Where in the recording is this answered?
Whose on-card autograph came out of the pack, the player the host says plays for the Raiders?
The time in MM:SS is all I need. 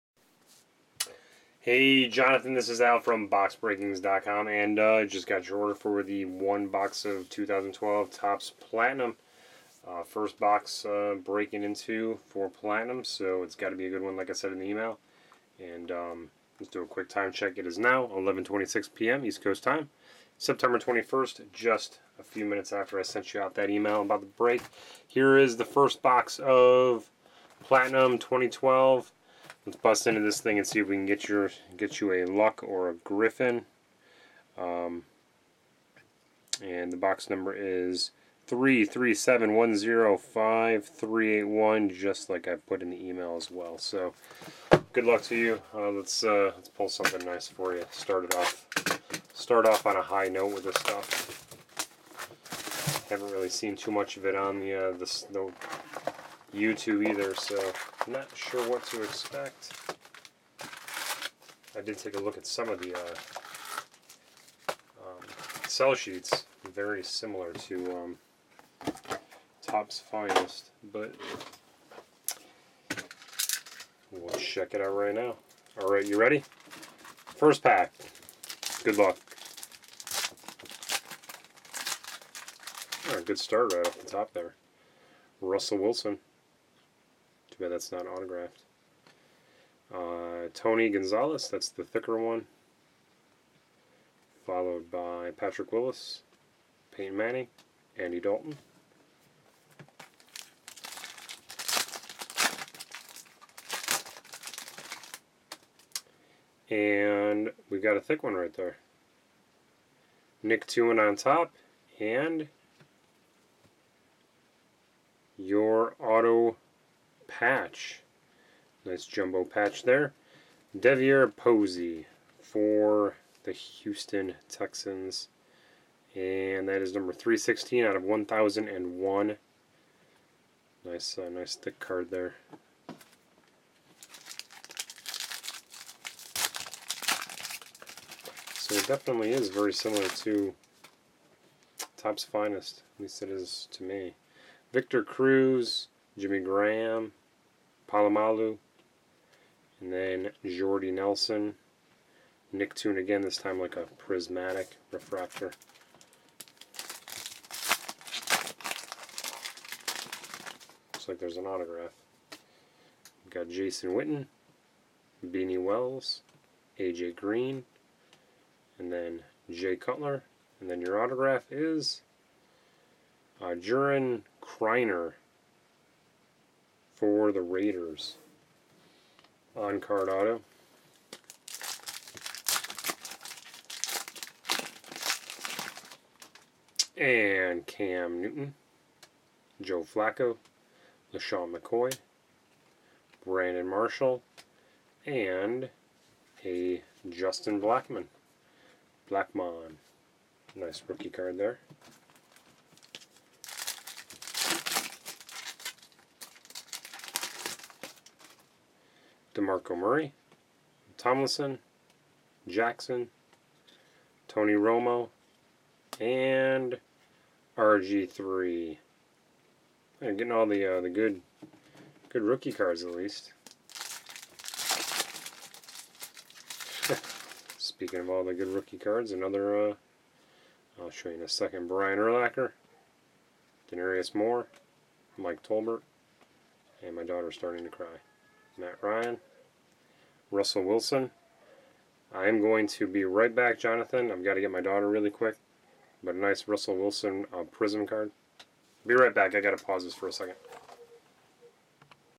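02:54.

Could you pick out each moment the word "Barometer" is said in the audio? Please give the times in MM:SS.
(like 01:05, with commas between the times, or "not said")
not said.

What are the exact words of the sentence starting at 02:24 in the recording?
Victor Cruz, Jimmy Graham, Polamalu, and then Jordy Nelson.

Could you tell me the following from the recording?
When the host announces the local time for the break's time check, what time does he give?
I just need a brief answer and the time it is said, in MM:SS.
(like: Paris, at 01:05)
11:26 p.m., at 00:18.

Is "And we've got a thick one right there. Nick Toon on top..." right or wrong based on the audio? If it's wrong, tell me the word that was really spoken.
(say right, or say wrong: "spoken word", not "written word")
right.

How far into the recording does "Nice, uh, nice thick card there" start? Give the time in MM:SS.
02:10.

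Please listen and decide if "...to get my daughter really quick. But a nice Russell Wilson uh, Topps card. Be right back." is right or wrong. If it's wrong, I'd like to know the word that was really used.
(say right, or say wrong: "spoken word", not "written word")
wrong: "Prism", not "Topps".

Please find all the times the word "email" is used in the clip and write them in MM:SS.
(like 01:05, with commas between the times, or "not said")
00:14, 00:23, 00:43.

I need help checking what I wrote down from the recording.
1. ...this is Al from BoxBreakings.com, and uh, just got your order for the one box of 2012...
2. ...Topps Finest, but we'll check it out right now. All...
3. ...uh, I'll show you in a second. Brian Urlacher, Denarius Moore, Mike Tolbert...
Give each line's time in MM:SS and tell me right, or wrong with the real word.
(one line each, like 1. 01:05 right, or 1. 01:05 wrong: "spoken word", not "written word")
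1. 00:02 right
2. 01:09 right
3. 03:49 right.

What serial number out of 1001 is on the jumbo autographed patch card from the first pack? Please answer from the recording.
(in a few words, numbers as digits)
316.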